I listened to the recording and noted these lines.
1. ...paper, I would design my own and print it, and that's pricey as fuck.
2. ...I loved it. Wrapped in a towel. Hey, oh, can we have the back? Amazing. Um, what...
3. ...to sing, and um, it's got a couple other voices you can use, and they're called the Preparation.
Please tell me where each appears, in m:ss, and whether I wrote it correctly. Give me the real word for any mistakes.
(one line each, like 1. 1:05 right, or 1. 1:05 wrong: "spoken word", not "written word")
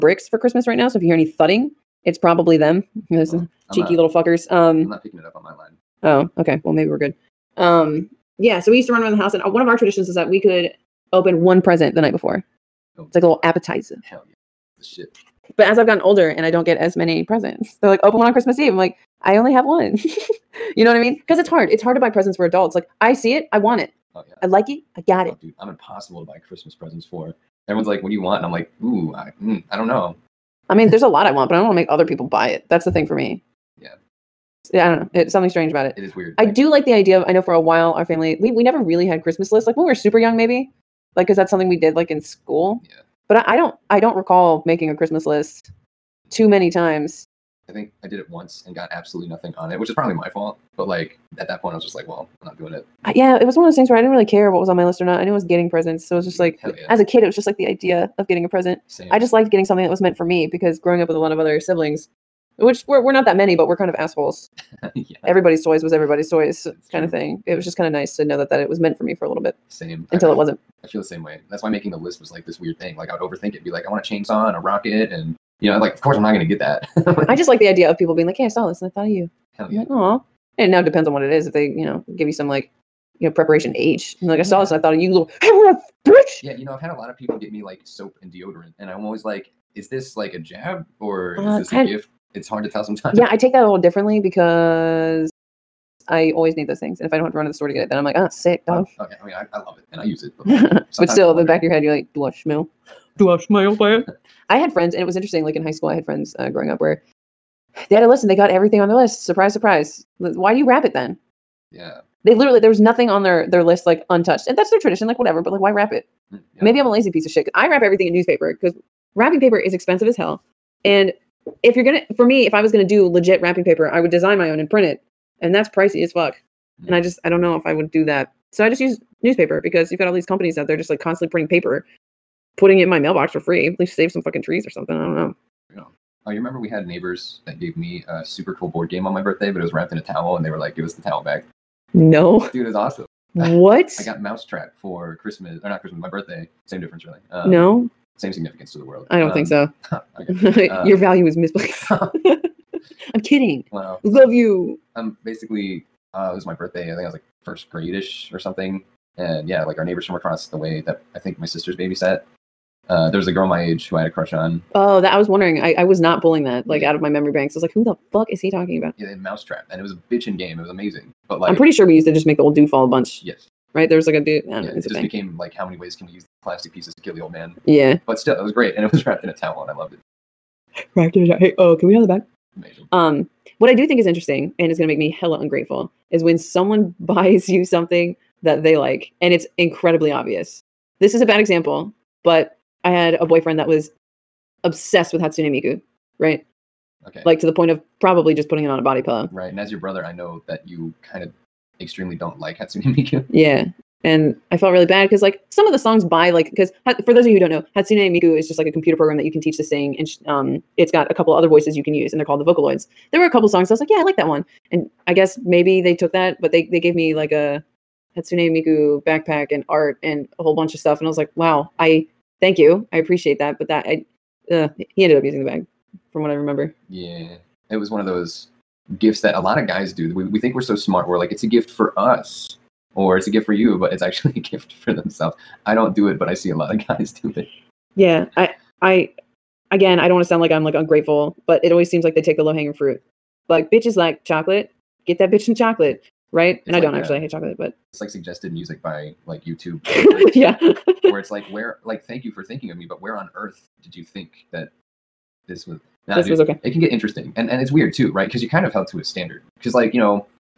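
1. 2:03 right
2. 2:59 right
3. 3:29 wrong: "Vocaloids", not "Preparation".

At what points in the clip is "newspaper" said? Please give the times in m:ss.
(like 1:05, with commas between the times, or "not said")
1:58, 2:09.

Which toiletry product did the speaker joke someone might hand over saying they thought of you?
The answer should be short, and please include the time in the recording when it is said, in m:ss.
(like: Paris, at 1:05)
Preparation H, at 1:23.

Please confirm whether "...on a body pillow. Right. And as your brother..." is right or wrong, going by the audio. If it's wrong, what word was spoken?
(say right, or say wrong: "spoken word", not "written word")
right.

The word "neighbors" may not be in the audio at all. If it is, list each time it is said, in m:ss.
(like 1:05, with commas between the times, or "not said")
2:16, 2:39.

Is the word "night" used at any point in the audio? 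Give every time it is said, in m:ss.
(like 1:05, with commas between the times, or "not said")
0:12.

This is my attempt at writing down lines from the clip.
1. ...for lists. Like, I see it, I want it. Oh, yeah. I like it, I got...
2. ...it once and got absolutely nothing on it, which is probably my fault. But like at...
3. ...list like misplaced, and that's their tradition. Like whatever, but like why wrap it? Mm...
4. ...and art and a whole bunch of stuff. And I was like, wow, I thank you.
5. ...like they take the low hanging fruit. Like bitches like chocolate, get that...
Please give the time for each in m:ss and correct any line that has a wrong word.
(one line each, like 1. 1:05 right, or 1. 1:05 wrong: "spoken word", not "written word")
1. 0:22 wrong: "adults", not "lists"
2. 0:48 right
3. 1:53 wrong: "untouched", not "misplaced"
4. 3:39 right
5. 4:02 right.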